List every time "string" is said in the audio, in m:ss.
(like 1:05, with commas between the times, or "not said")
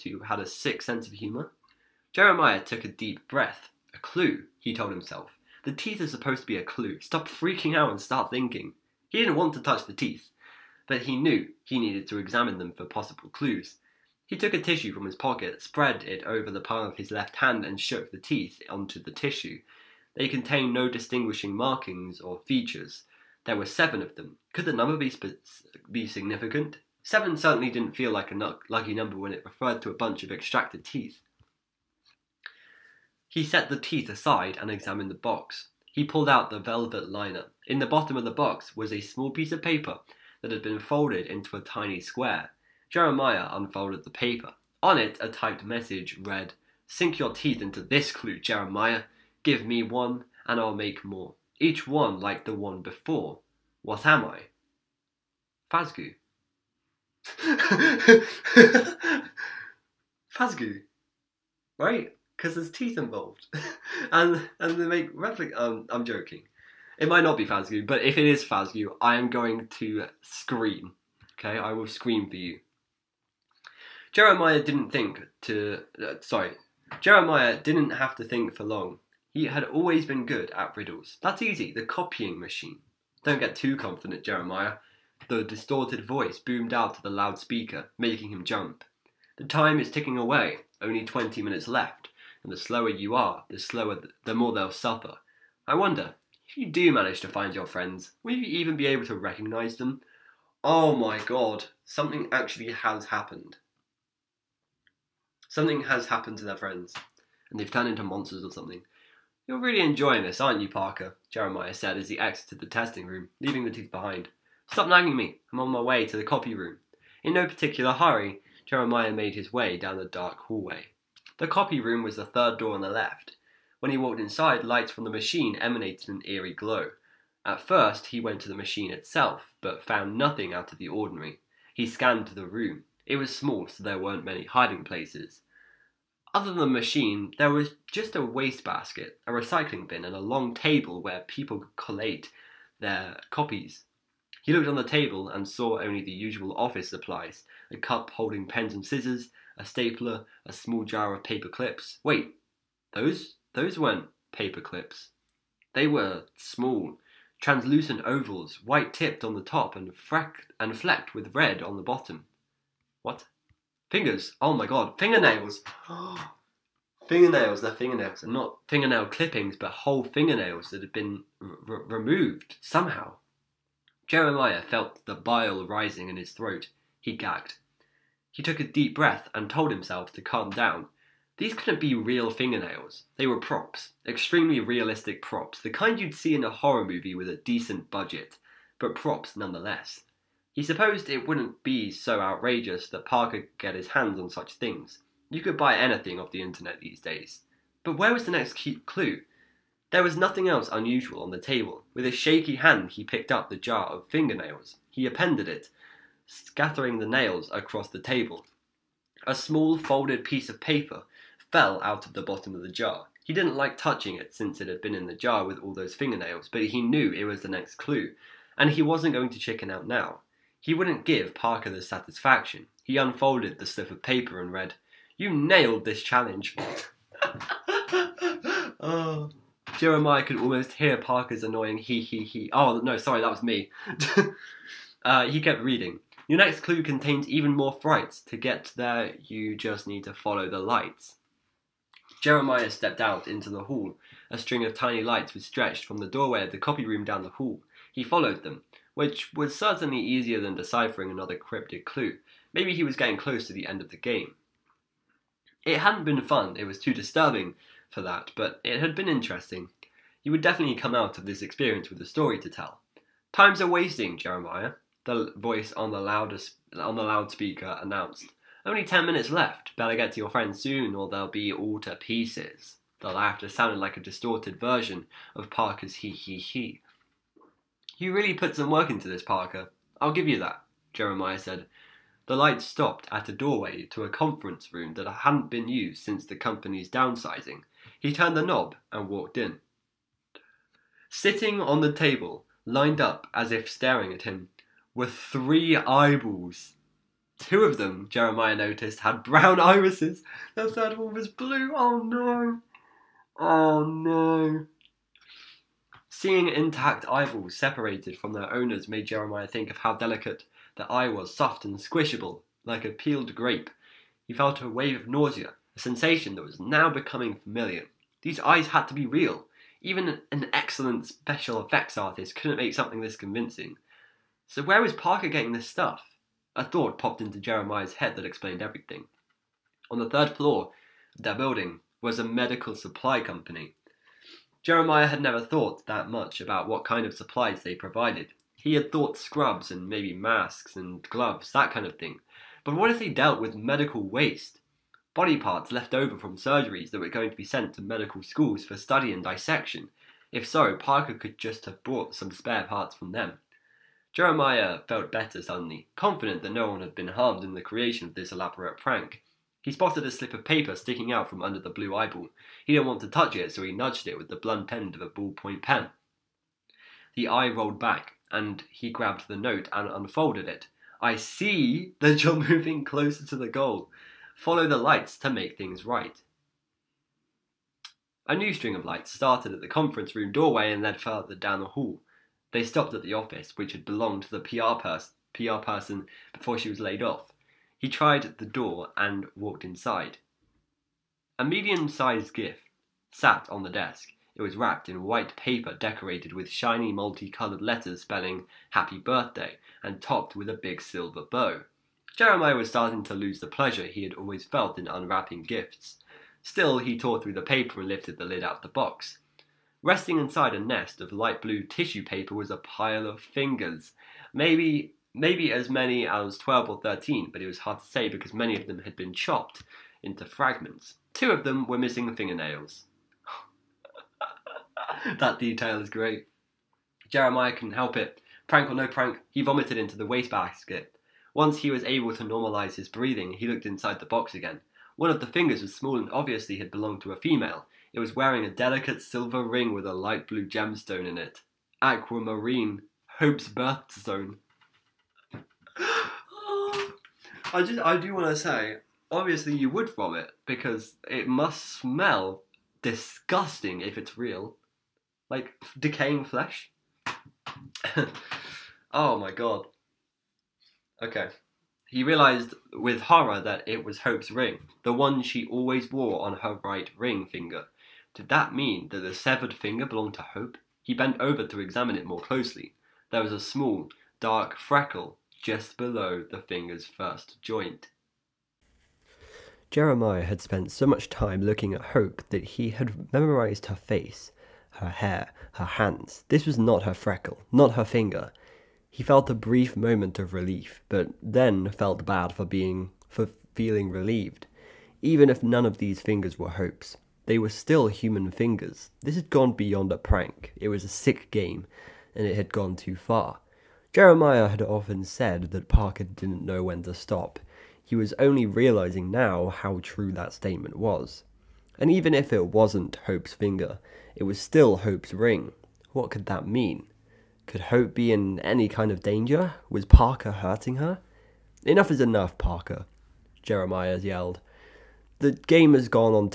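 4:04, 6:18.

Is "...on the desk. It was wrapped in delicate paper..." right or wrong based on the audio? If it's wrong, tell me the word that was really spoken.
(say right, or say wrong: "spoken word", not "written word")
wrong: "white", not "delicate".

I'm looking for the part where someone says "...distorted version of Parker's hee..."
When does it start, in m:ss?
4:33.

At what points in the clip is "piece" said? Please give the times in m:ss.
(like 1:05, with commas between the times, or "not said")
0:39, 3:30, 4:31.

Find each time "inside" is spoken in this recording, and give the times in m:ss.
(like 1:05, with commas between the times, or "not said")
2:04, 6:29, 6:50, 7:13.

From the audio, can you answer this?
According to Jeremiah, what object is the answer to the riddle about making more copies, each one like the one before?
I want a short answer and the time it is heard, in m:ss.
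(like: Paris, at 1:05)
The copying machine, at 1:21.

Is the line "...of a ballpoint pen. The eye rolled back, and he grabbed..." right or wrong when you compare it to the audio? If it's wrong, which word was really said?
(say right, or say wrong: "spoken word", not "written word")
right.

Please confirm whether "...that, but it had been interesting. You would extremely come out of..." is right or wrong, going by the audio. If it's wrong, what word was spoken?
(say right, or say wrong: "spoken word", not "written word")
wrong: "definitely", not "extremely".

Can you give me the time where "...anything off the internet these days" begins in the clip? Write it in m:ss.
3:15.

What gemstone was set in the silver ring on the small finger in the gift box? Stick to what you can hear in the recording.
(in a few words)
Aquamarine.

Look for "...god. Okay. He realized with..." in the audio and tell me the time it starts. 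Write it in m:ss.
7:39.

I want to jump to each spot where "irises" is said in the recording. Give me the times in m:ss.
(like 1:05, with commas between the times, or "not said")
4:59.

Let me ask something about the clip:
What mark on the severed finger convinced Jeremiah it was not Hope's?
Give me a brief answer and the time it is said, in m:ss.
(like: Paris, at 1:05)
A small, dark freckle, at 7:53.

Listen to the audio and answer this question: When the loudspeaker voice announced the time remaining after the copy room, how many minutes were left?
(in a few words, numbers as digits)
10.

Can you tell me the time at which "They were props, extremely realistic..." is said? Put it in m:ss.
3:03.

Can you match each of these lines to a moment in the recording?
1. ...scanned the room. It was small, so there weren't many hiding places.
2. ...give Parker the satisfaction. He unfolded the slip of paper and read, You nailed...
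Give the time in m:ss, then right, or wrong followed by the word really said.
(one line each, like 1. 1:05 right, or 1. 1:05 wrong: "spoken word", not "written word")
1. 2:11 right
2. 3:41 right.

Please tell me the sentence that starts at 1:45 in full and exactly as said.
Something has happened to their friends, and they've turned into monsters or something.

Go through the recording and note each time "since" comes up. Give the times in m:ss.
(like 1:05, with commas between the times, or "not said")
3:34, 4:46.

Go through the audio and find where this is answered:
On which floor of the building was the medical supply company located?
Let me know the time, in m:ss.
5:29.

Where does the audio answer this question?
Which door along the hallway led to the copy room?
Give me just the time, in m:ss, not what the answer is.
2:02.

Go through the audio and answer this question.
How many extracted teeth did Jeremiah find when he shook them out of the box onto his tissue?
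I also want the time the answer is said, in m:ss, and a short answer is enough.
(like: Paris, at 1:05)
7, at 0:23.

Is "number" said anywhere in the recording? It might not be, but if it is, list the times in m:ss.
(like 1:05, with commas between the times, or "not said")
0:24, 0:28.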